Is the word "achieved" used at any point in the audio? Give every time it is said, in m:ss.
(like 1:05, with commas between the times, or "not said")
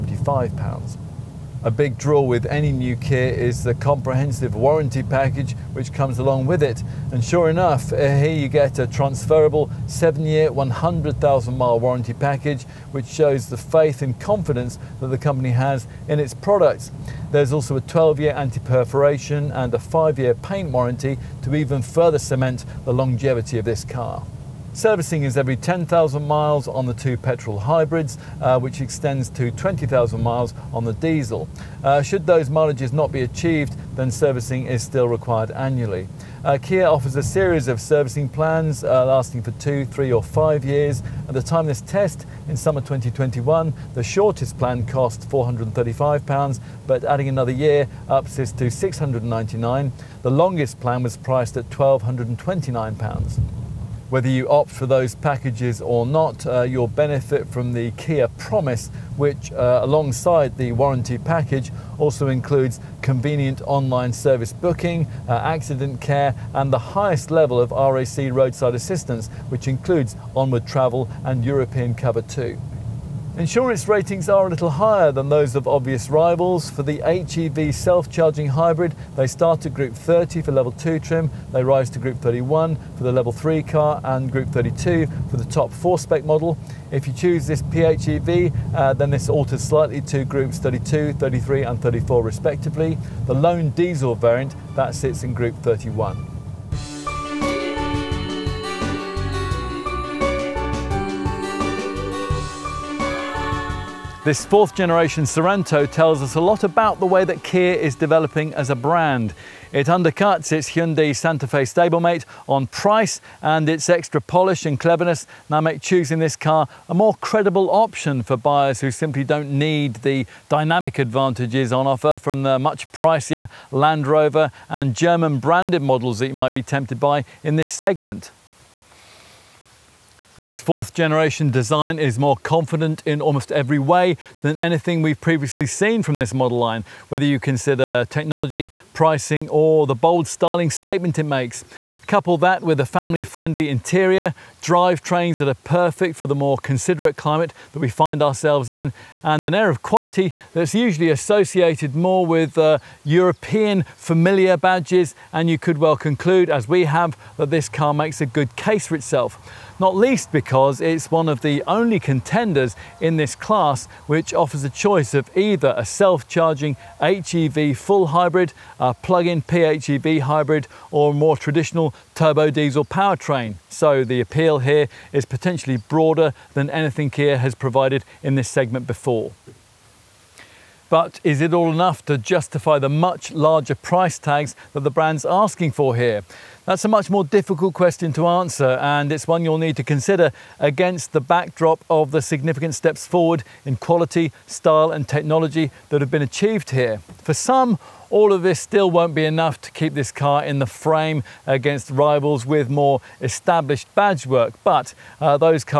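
0:33, 3:16.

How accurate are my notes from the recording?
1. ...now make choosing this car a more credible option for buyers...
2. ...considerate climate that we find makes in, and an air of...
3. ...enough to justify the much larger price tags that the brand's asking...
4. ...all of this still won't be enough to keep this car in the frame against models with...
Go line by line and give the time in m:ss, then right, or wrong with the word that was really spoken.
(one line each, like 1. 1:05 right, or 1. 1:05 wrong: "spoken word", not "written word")
1. 1:55 right
2. 2:26 wrong: "ourselves", not "makes"
3. 3:01 right
4. 3:18 wrong: "rivals", not "models".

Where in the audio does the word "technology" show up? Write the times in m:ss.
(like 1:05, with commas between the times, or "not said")
2:18, 3:15.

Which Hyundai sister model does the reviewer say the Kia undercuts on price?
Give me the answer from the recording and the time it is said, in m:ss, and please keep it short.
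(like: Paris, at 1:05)
Hyundai Santa Fe, at 1:50.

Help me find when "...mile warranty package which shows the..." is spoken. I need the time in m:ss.
0:11.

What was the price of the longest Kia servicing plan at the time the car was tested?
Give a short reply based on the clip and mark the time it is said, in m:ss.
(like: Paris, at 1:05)
£1,229, at 0:51.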